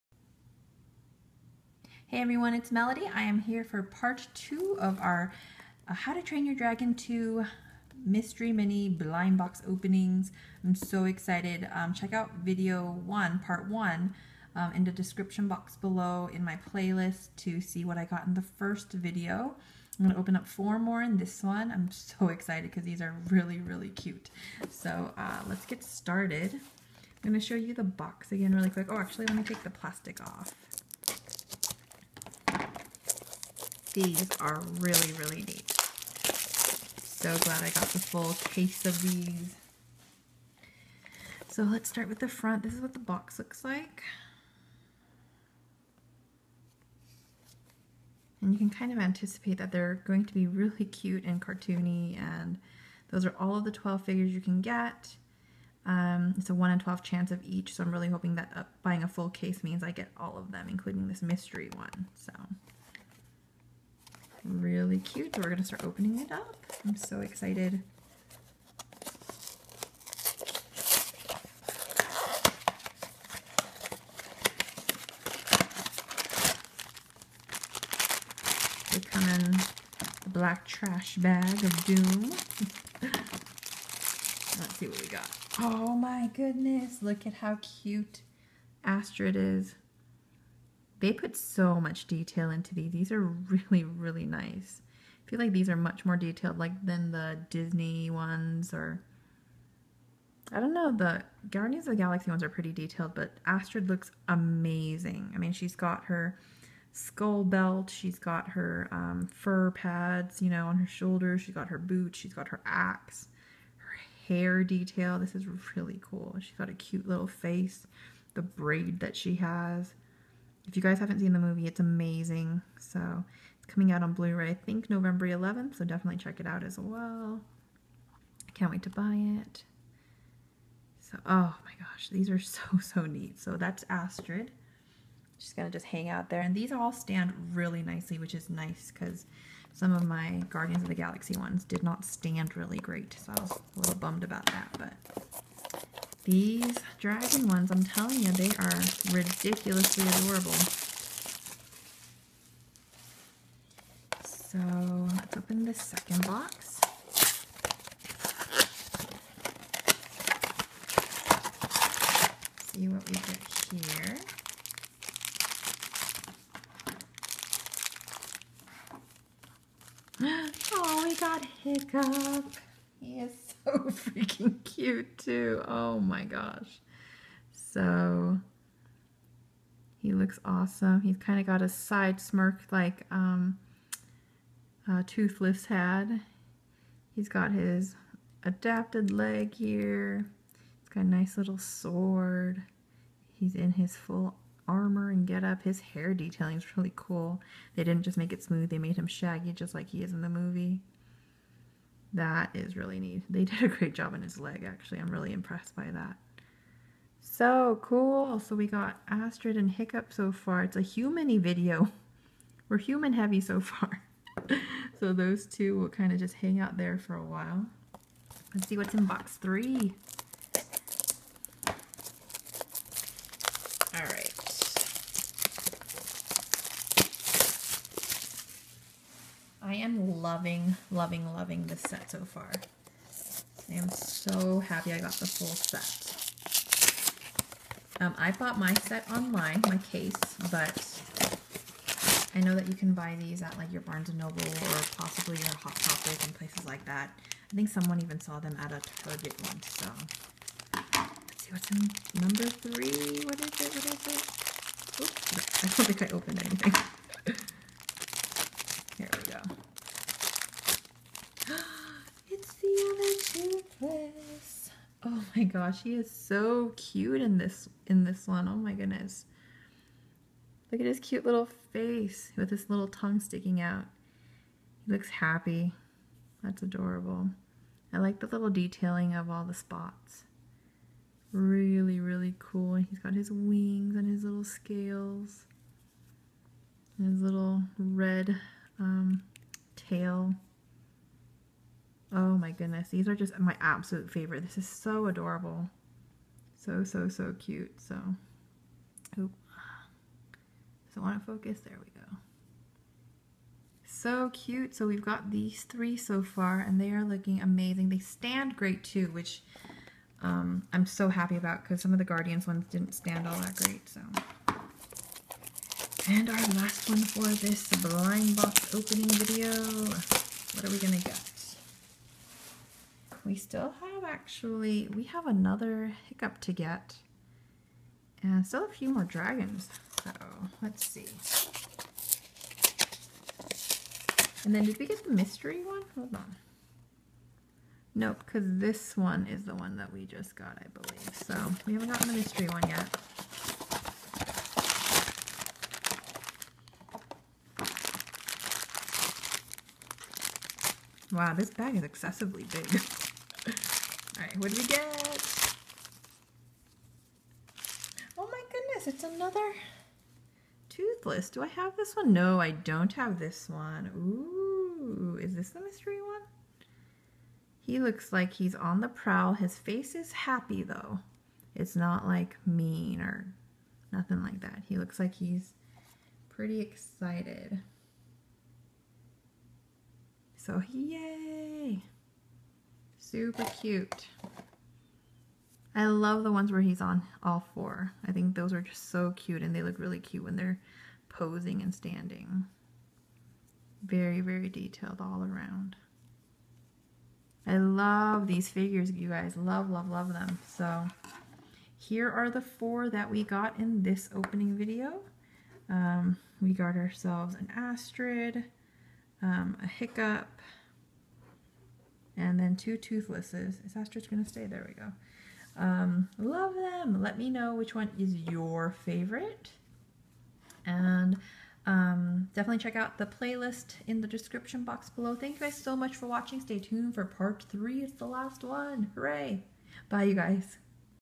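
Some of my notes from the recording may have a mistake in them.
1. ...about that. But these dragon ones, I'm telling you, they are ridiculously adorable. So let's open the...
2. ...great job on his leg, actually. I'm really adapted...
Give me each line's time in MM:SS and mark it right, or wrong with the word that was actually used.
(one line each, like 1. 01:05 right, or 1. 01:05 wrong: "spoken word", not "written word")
1. 02:24 right
2. 03:23 wrong: "impressed", not "adapted".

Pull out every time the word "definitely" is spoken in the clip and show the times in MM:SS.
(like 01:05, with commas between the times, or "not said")
02:05, 07:02.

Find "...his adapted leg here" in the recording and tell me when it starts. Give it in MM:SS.
03:07.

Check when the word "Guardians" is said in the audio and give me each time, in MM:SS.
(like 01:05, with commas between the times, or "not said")
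01:41, 02:20, 05:12.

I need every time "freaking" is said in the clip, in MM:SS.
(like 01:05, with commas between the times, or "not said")
02:53.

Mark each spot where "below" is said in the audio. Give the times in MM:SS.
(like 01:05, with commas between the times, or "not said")
00:15, 07:04.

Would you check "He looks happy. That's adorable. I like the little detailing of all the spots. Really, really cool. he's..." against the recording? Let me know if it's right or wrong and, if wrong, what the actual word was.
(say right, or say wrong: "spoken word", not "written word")
right.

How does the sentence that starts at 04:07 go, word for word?
I think someone even saw them at a Target once, so.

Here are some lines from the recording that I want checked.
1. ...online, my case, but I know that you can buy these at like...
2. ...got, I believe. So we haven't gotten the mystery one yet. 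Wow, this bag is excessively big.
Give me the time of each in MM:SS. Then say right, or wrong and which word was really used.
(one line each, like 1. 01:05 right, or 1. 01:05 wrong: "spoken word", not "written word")
1. 03:59 right
2. 05:40 right.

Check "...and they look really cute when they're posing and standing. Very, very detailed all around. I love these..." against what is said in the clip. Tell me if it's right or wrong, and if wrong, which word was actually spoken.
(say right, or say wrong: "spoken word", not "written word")
right.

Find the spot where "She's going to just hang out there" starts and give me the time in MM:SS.
02:15.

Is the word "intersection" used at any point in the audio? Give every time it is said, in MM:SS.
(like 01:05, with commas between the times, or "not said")
not said.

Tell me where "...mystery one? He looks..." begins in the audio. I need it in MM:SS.
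06:05.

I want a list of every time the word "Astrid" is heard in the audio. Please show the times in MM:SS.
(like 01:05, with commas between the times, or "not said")
01:28, 01:43, 02:13, 03:29, 06:47, 06:53.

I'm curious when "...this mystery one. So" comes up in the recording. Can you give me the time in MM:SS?
01:01.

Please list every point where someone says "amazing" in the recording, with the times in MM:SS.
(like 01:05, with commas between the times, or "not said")
01:44, 02:01, 05:07.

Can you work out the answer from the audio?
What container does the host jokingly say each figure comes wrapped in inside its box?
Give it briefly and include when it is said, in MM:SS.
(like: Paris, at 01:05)
black trash bag of doom, at 01:20.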